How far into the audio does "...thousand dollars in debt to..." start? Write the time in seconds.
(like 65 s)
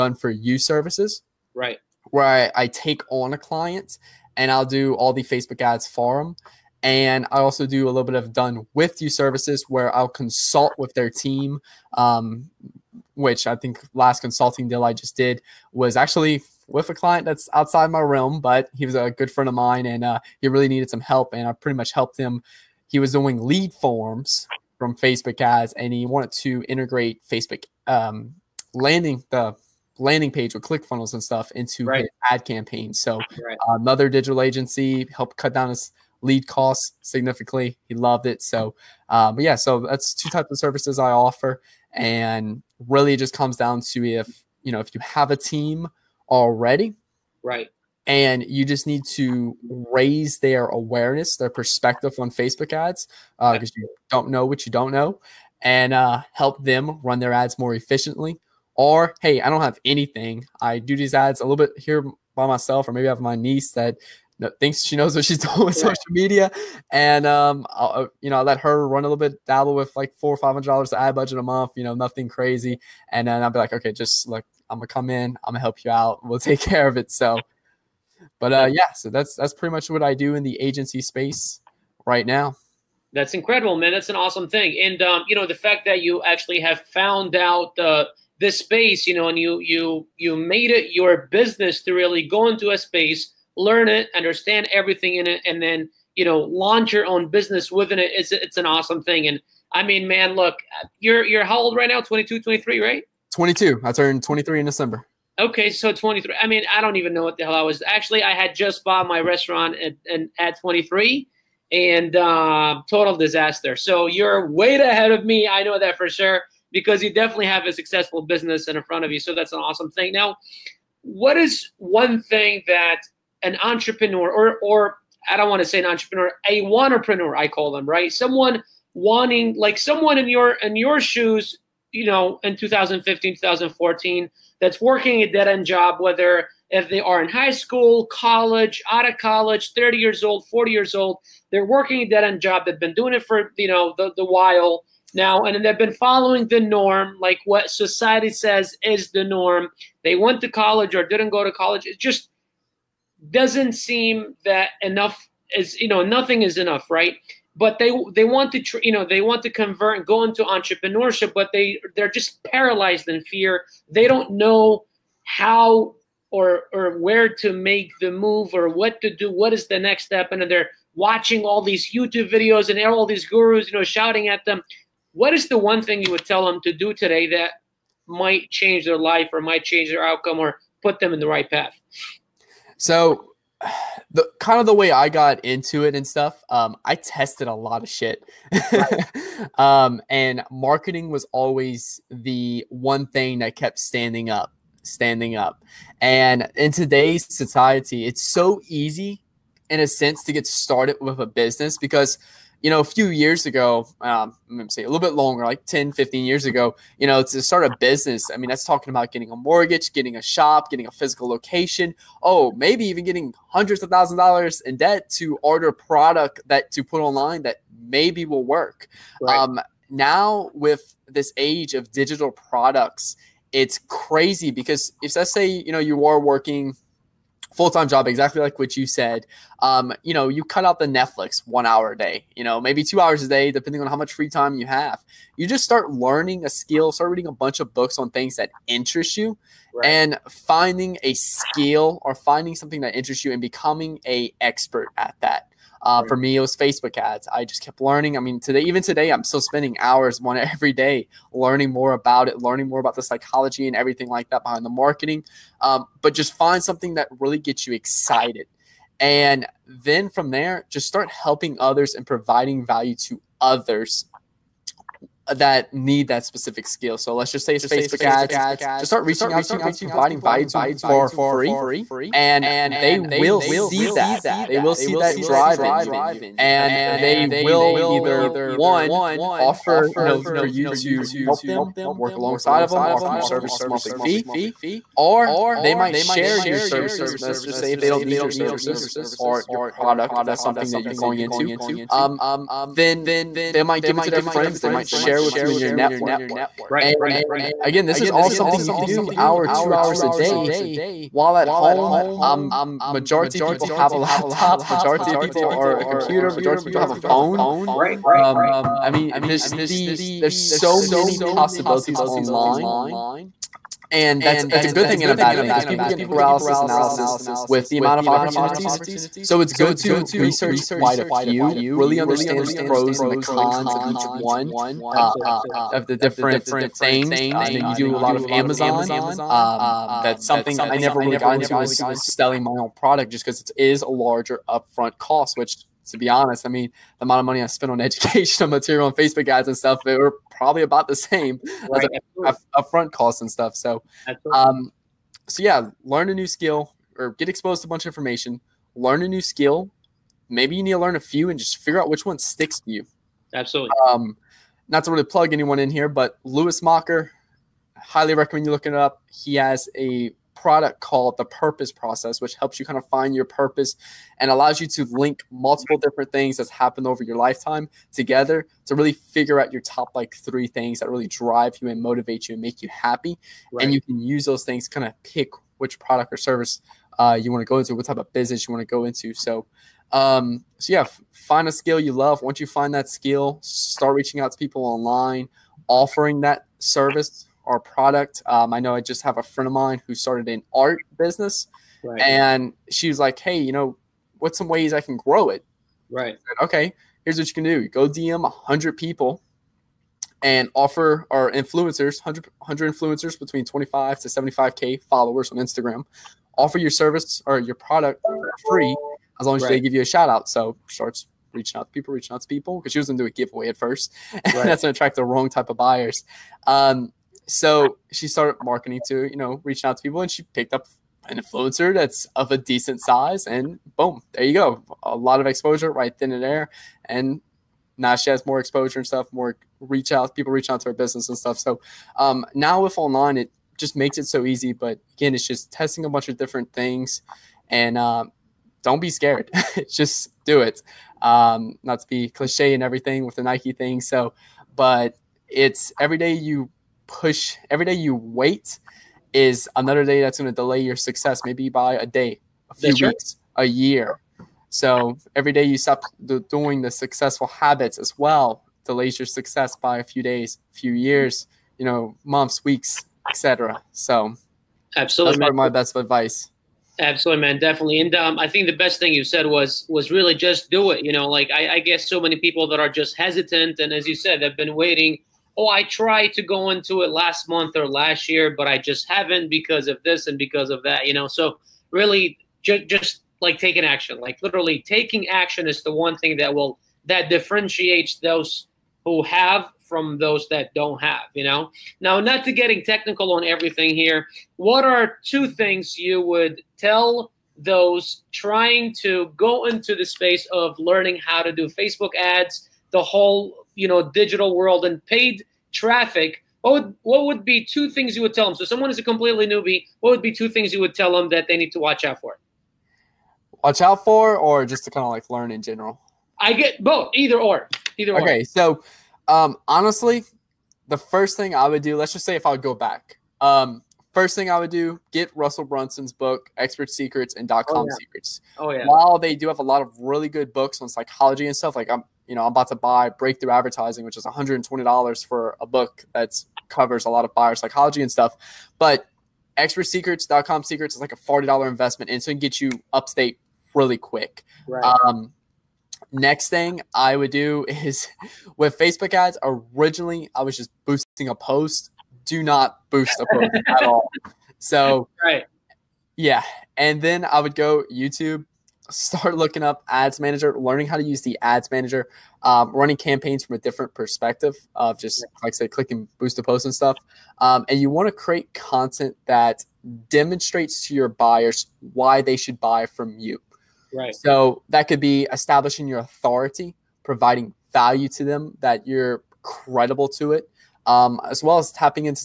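213 s.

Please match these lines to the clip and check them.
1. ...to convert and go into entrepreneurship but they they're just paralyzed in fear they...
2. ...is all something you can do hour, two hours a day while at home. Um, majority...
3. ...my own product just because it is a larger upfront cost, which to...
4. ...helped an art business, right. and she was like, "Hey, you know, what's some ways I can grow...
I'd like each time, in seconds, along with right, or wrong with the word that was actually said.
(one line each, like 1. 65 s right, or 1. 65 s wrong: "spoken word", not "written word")
1. 159 s right
2. 298 s right
3. 332 s right
4. 389 s wrong: "started", not "helped".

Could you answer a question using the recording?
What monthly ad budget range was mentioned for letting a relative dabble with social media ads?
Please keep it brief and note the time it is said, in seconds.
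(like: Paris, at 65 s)
$400-500, at 70 s.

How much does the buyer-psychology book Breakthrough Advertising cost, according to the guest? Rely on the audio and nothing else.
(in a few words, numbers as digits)
$120.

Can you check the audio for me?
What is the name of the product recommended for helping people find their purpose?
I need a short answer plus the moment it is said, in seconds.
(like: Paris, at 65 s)
The Purpose Process, at 361 s.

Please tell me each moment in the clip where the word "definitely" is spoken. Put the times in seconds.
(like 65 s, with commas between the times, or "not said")
117 s, 467 s.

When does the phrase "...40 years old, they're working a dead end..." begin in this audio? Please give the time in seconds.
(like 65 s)
140 s.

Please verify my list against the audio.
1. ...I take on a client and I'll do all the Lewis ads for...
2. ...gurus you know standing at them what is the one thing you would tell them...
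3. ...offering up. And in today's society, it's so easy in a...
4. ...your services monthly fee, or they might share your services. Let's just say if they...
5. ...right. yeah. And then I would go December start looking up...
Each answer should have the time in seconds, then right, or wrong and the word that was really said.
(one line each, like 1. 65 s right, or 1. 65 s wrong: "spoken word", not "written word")
1. 2 s wrong: "Facebook", not "Lewis"
2. 173 s wrong: "shouting", not "standing"
3. 194 s wrong: "standing", not "offering"
4. 283 s right
5. 555 s wrong: "YouTube", not "December".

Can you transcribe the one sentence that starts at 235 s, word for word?
You just start learning a skill, start reading a bunch of books on things that interest you, right.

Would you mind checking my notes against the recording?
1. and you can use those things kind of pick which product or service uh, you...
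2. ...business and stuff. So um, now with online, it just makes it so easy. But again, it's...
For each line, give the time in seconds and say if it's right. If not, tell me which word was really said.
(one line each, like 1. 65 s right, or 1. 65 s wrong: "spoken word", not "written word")
1. 373 s right
2. 430 s right.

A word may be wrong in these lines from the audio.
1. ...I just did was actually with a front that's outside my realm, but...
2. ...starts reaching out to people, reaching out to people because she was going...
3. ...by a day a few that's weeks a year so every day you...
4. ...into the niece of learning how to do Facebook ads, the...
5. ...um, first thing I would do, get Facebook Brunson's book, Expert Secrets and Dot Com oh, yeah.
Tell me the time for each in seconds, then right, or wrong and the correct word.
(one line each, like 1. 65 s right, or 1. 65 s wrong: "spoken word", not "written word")
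1. 14 s wrong: "client", not "front"
2. 410 s right
3. 451 s right
4. 499 s wrong: "space", not "niece"
5. 523 s wrong: "Russell", not "Facebook".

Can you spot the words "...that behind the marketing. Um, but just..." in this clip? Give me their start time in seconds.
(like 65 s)
254 s.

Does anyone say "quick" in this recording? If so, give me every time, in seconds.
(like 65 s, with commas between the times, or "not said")
543 s.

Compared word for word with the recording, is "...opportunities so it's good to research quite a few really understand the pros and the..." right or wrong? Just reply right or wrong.
right.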